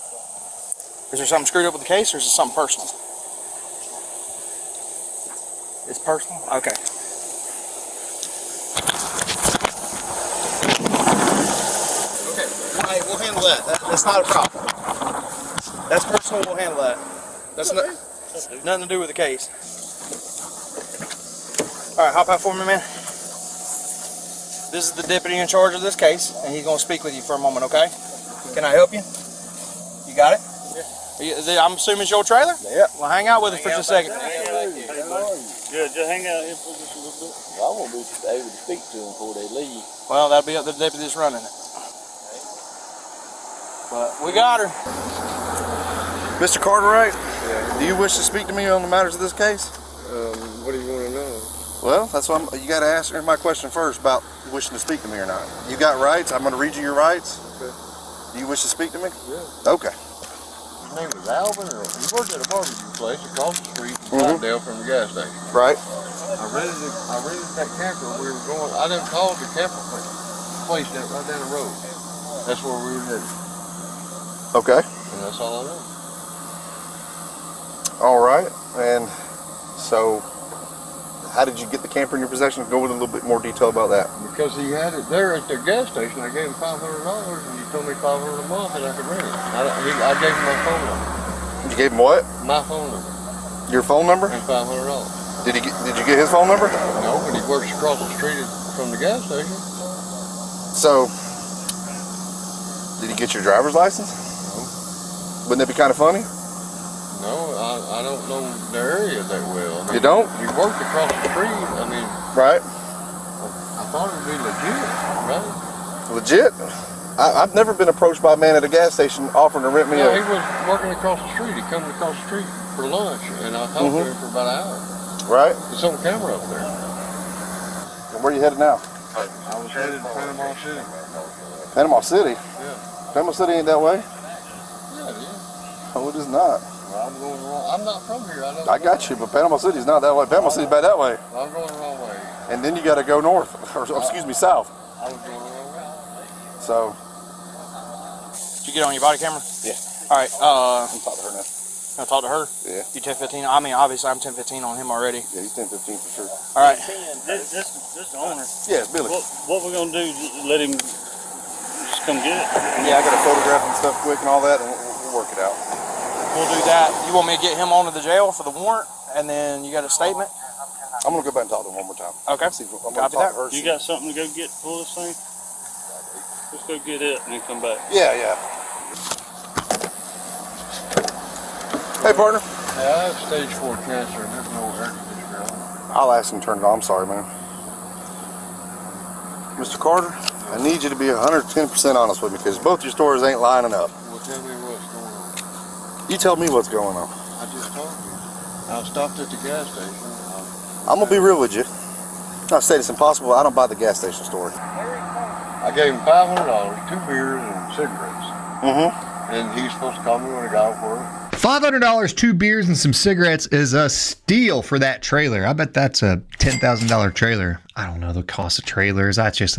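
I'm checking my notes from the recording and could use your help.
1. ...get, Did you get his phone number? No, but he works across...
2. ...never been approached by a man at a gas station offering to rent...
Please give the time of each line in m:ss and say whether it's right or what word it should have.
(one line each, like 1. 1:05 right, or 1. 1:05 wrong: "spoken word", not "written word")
1. 1:35 right
2. 1:57 right.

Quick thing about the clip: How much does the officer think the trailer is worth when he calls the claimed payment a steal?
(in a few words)
$10,000.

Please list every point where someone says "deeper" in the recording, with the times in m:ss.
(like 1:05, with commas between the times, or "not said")
not said.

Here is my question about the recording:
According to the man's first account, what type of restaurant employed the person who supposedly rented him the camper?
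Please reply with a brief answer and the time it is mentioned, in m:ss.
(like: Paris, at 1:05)
barbecue place, at 1:02.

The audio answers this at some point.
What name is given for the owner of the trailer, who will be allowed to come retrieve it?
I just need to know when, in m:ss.
2:38.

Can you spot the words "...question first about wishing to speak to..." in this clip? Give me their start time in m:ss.
0:53.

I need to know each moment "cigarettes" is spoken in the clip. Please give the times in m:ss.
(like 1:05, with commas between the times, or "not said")
3:27, 3:32.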